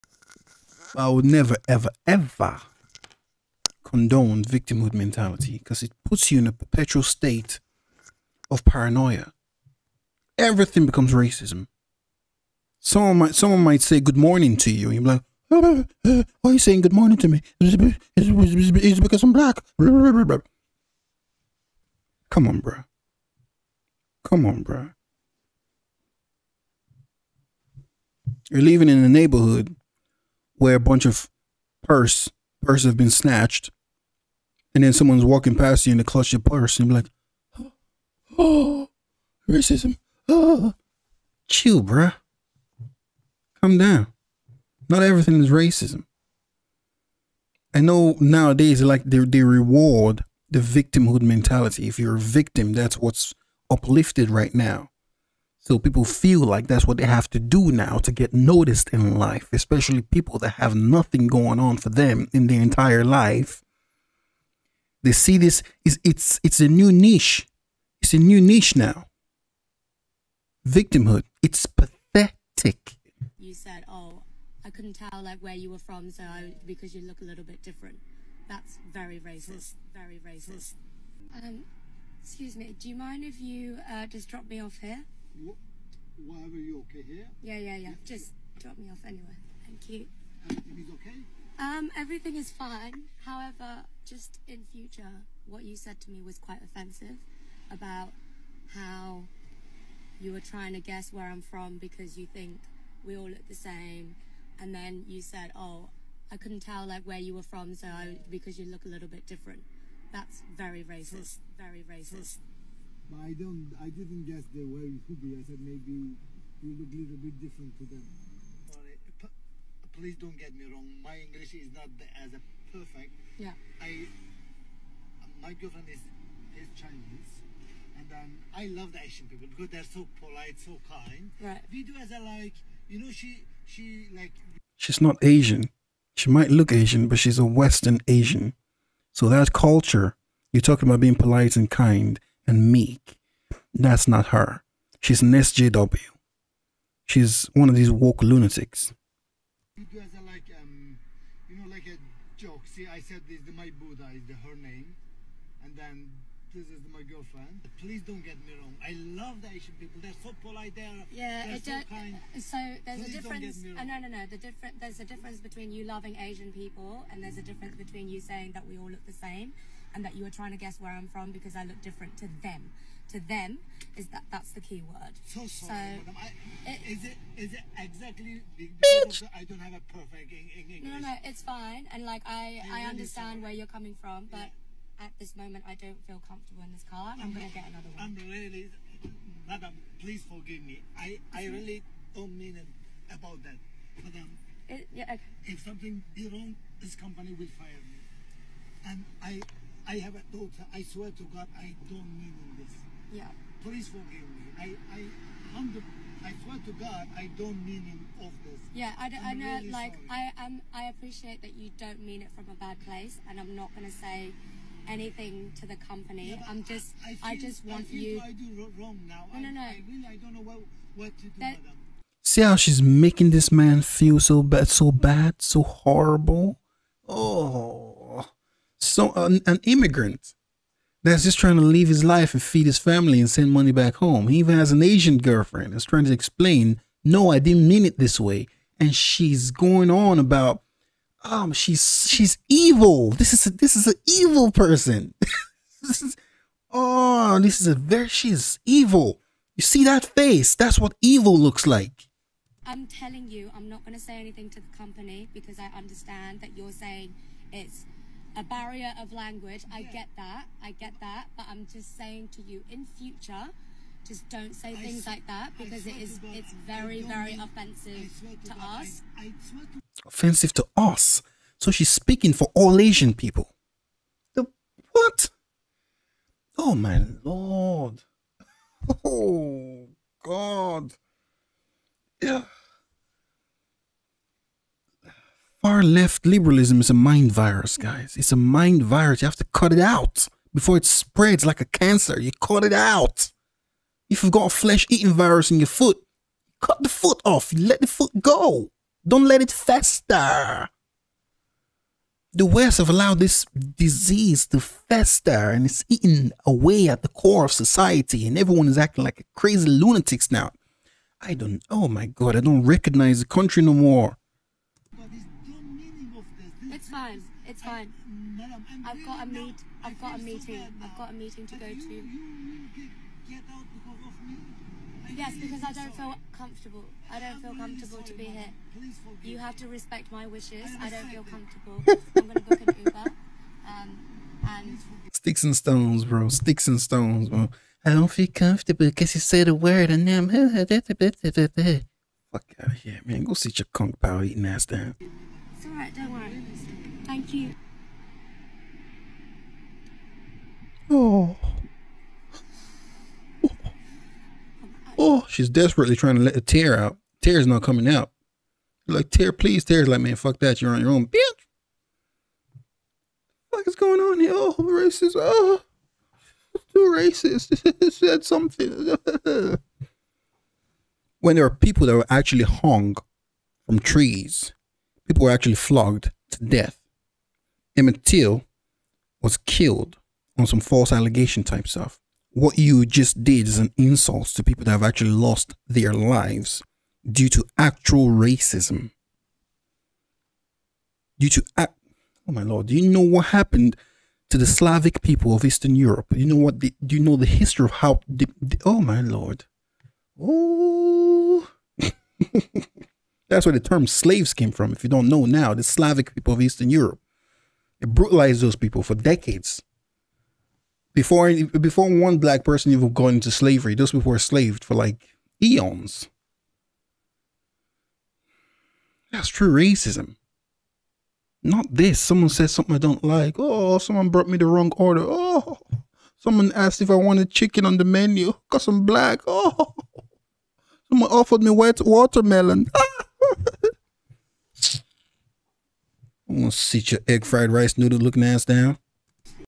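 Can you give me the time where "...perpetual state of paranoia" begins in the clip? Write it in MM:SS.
00:06.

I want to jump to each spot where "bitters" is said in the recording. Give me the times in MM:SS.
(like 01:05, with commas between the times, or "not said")
not said.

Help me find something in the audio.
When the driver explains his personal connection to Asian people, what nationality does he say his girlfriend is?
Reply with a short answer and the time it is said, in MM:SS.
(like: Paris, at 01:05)
Chinese, at 02:06.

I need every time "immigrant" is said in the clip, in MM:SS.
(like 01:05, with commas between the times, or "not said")
03:49.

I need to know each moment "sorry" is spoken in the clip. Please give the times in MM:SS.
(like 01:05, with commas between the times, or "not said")
01:58, 02:55, 03:03, 03:30.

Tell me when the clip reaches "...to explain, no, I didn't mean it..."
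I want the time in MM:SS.
03:56.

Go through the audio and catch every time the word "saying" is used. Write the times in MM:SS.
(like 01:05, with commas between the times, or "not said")
00:16, 02:48, 04:16, 04:21.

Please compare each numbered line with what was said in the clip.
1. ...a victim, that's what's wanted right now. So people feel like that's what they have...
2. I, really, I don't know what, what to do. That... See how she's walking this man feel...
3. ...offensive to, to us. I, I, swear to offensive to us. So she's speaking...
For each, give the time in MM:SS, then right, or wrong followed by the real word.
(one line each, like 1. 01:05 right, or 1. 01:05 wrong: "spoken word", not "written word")
1. 00:52 wrong: "uplifted", not "wanted"
2. 03:39 wrong: "making", not "walking"
3. 04:27 right.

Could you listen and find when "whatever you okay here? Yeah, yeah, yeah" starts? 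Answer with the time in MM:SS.
01:26.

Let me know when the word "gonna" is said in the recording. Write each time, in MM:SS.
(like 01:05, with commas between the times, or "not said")
03:33, 05:32, 07:16.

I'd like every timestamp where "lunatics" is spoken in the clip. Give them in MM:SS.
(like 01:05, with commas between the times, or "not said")
02:28, 05:09.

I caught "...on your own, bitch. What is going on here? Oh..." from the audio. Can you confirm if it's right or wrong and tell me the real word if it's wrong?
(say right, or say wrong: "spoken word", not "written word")
right.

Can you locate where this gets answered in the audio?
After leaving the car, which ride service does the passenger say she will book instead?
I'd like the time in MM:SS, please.
05:32.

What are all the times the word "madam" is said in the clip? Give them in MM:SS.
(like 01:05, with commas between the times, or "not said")
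03:09, 03:14.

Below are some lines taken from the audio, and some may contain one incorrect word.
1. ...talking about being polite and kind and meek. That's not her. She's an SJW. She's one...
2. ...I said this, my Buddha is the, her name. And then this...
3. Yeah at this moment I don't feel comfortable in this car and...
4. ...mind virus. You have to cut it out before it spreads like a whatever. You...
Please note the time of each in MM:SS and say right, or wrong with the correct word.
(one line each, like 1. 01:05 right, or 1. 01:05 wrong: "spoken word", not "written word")
1. 02:20 right
2. 02:32 right
3. 03:04 right
4. 04:48 wrong: "cancer", not "whatever".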